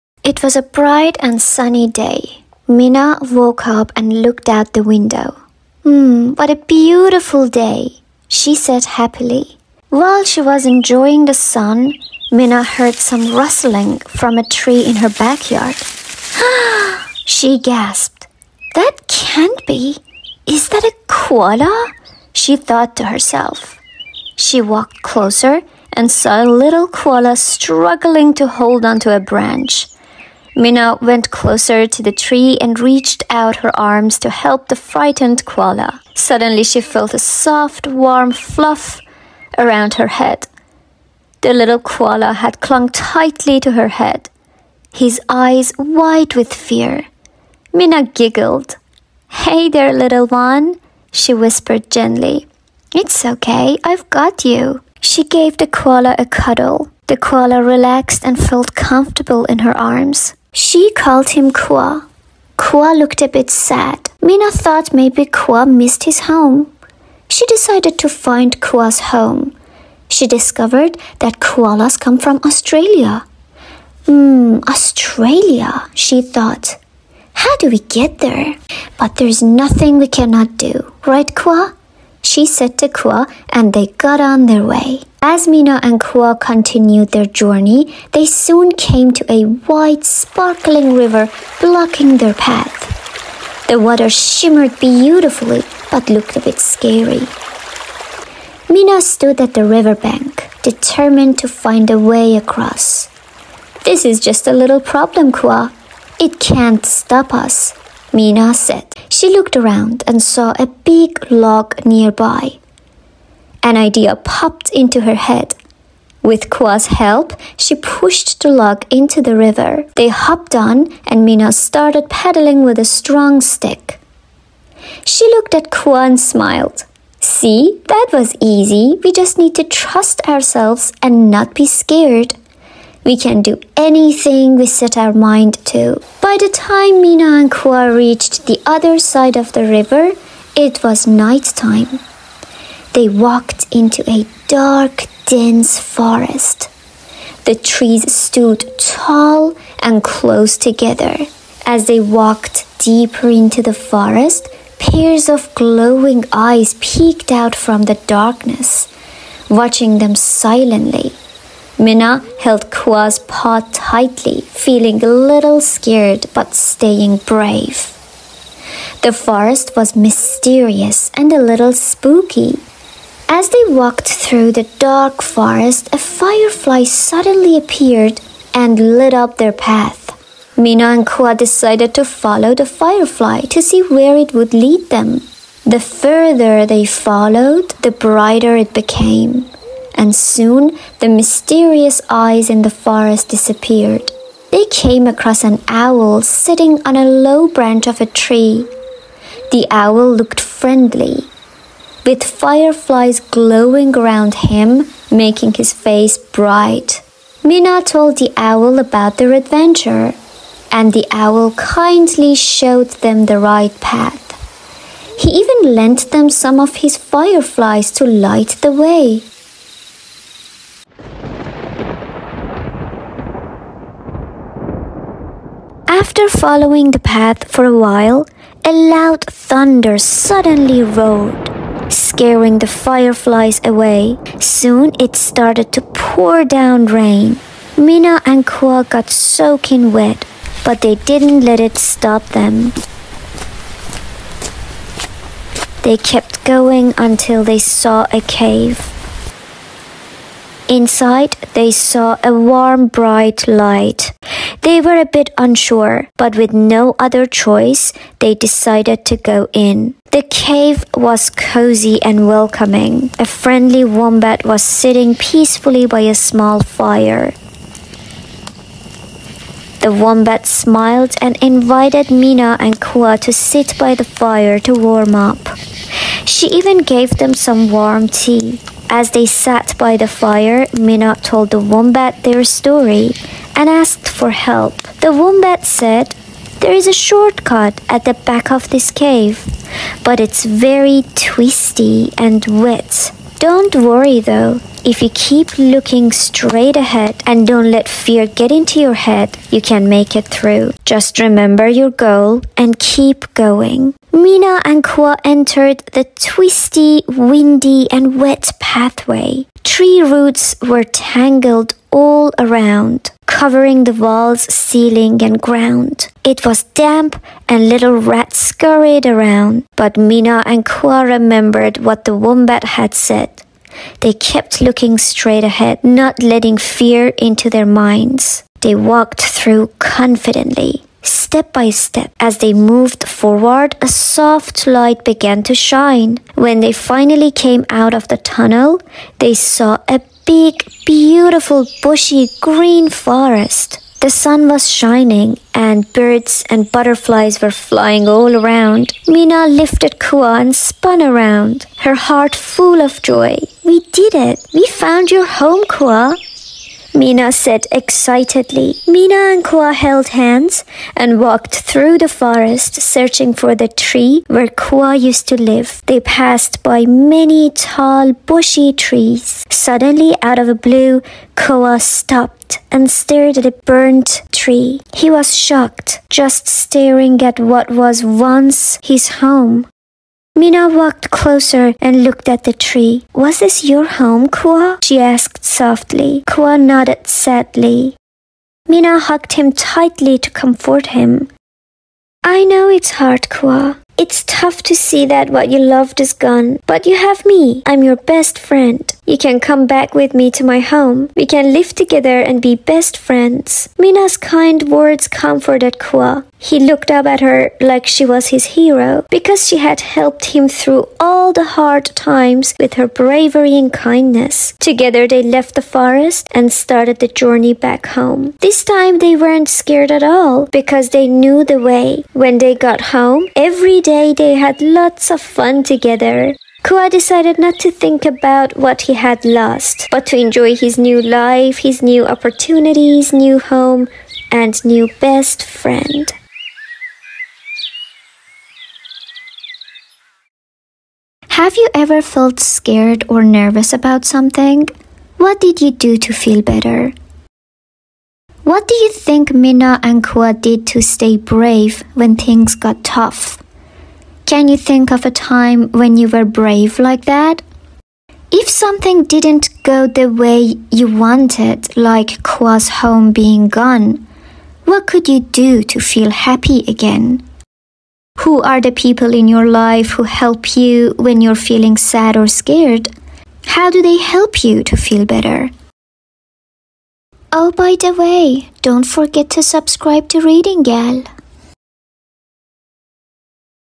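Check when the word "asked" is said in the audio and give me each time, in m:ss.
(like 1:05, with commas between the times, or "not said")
4:43, 6:24.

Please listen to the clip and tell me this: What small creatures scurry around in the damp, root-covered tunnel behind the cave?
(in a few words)
rats.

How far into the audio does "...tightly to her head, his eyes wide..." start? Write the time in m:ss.
0:42.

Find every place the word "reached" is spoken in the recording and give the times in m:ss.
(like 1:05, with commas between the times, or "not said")
0:32, 2:17.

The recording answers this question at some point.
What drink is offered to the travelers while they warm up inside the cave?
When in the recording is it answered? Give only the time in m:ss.
4:37.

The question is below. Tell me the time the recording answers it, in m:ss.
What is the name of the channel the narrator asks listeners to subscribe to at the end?
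8:00.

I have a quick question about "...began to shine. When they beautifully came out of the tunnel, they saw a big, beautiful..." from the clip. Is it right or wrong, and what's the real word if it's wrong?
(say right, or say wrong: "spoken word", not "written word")
wrong: "finally", not "beautifully".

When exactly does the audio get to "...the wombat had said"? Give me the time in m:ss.
5:22.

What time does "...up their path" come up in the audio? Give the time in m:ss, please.
2:59.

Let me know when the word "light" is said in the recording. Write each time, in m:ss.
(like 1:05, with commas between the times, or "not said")
3:38, 4:13, 5:34.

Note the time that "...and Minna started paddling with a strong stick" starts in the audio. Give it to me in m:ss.
2:01.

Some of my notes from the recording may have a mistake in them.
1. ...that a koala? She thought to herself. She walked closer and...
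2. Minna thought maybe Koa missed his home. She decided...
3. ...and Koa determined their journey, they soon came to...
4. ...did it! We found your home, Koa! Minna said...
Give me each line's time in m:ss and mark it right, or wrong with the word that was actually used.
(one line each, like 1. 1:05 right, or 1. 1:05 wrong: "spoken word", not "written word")
1. 0:20 right
2. 1:04 right
3. 1:25 wrong: "continued", not "determined"
4. 5:53 right.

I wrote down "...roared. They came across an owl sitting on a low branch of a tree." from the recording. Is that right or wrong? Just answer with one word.
wrong.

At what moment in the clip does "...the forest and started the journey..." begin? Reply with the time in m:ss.
6:55.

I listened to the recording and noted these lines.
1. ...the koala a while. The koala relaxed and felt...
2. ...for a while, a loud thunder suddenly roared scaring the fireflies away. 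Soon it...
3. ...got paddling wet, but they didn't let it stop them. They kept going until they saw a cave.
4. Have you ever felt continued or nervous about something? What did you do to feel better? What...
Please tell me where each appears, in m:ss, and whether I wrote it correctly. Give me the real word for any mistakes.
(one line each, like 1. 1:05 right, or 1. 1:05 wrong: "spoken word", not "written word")
1. 0:55 wrong: "cuddle", not "while"
2. 3:47 right
3. 3:58 wrong: "soaking", not "paddling"
4. 7:21 wrong: "scared", not "continued".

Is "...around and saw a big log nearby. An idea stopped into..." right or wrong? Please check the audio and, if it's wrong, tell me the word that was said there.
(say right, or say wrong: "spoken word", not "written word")
wrong: "popped", not "stopped".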